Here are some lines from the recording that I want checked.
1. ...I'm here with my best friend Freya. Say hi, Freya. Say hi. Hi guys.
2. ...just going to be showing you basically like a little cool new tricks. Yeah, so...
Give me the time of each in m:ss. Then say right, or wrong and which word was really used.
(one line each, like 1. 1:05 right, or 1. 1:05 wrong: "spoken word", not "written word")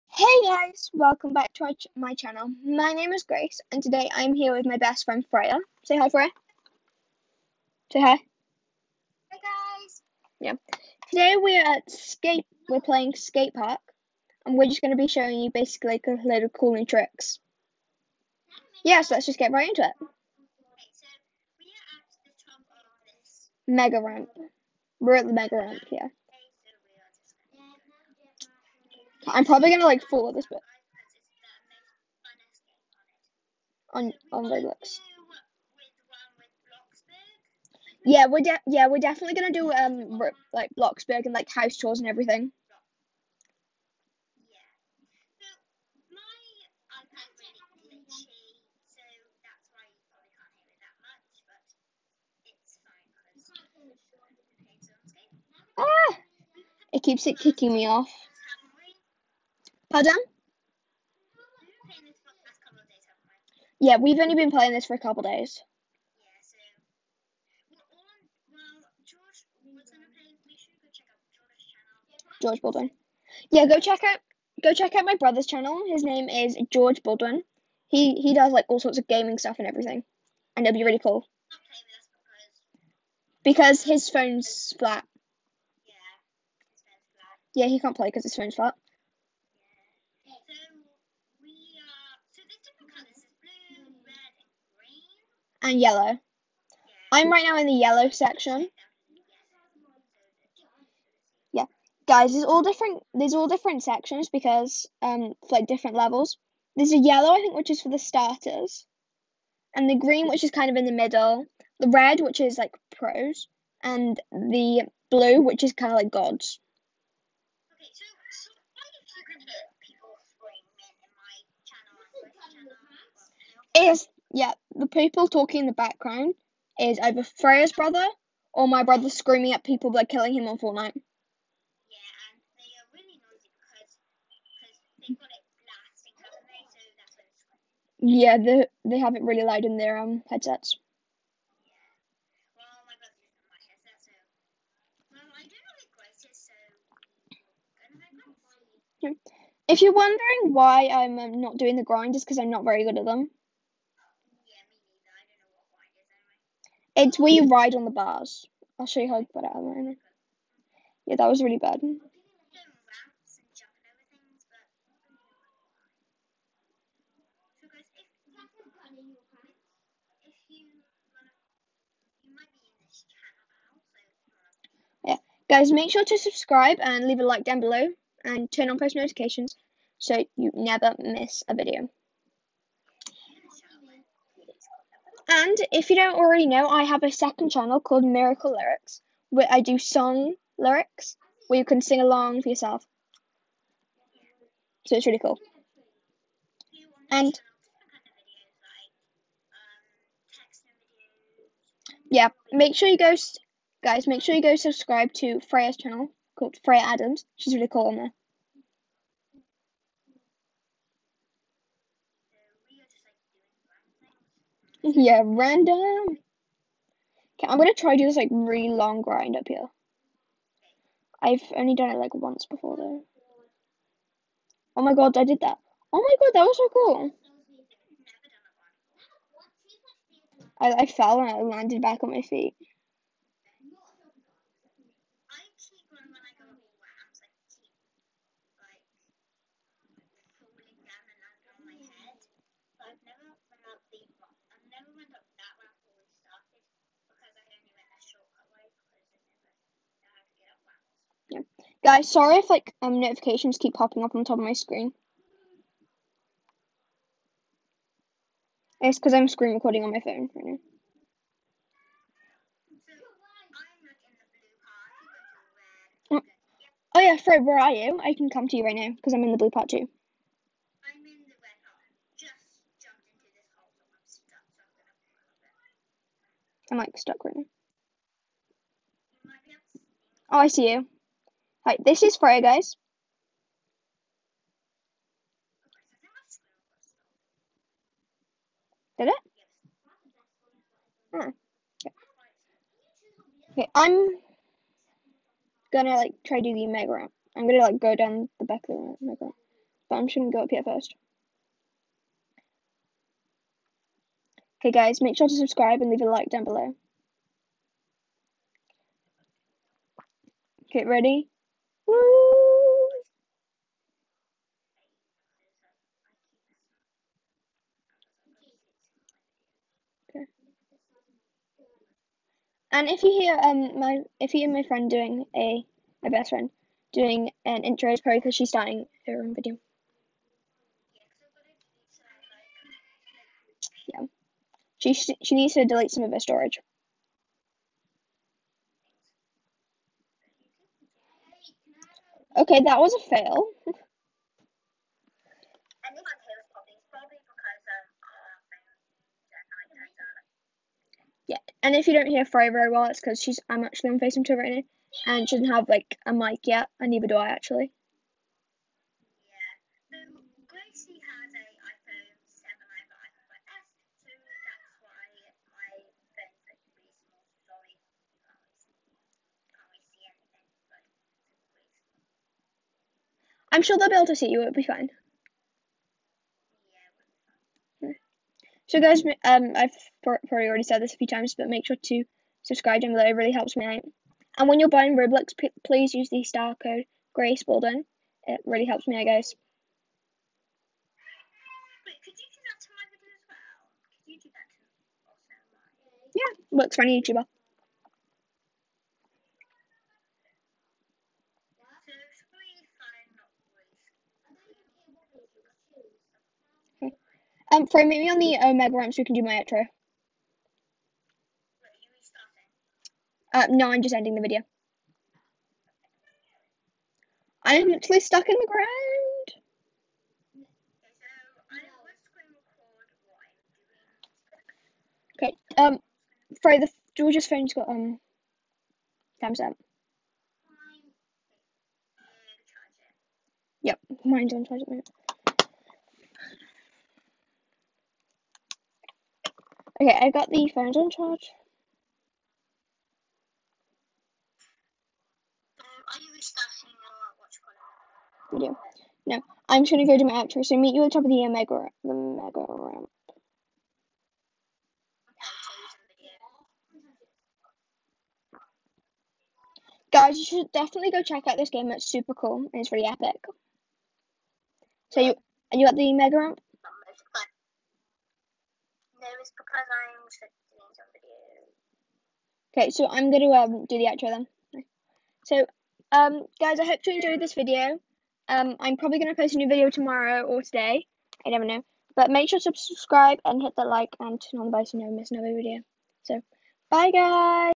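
1. 0:04 right
2. 0:14 right.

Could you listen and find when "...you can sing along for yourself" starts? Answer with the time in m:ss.
3:11.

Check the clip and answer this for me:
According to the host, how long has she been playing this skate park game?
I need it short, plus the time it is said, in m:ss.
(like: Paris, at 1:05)
a couple of days, at 1:04.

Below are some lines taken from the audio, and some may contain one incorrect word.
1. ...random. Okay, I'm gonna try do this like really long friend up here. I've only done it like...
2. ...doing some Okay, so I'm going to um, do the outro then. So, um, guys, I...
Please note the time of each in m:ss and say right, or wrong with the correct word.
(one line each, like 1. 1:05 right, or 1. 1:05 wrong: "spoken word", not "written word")
1. 3:35 wrong: "grind", not "friend"
2. 7:50 right.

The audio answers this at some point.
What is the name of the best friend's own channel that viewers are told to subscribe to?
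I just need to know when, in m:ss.
3:26.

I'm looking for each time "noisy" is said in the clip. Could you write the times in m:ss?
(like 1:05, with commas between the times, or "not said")
2:13.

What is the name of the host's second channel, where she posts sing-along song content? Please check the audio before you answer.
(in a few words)
Miracle Lyrics.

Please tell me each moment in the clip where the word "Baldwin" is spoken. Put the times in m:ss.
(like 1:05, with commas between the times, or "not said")
1:12, 1:17.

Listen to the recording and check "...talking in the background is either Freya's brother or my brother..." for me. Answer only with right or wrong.
right.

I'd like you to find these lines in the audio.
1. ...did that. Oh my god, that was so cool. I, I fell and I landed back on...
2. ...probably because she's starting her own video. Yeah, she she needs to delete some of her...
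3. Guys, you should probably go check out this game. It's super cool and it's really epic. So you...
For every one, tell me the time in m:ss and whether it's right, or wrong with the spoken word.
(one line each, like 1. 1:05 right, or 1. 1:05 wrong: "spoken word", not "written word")
1. 3:45 right
2. 5:28 right
3. 7:39 wrong: "definitely", not "probably".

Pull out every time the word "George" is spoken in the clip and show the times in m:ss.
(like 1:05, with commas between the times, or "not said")
1:12, 1:16, 7:06.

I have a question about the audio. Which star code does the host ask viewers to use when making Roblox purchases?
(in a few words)
Grace Bolden.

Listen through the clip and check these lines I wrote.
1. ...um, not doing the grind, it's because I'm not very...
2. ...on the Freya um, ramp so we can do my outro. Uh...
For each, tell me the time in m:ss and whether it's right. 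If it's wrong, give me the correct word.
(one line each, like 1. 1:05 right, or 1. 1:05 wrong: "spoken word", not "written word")
1. 2:31 right
2. 6:48 wrong: "Omega", not "Freya".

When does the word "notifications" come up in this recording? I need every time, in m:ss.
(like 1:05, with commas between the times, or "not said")
2:58, 4:13.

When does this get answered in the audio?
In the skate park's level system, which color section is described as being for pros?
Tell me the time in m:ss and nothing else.
1:51.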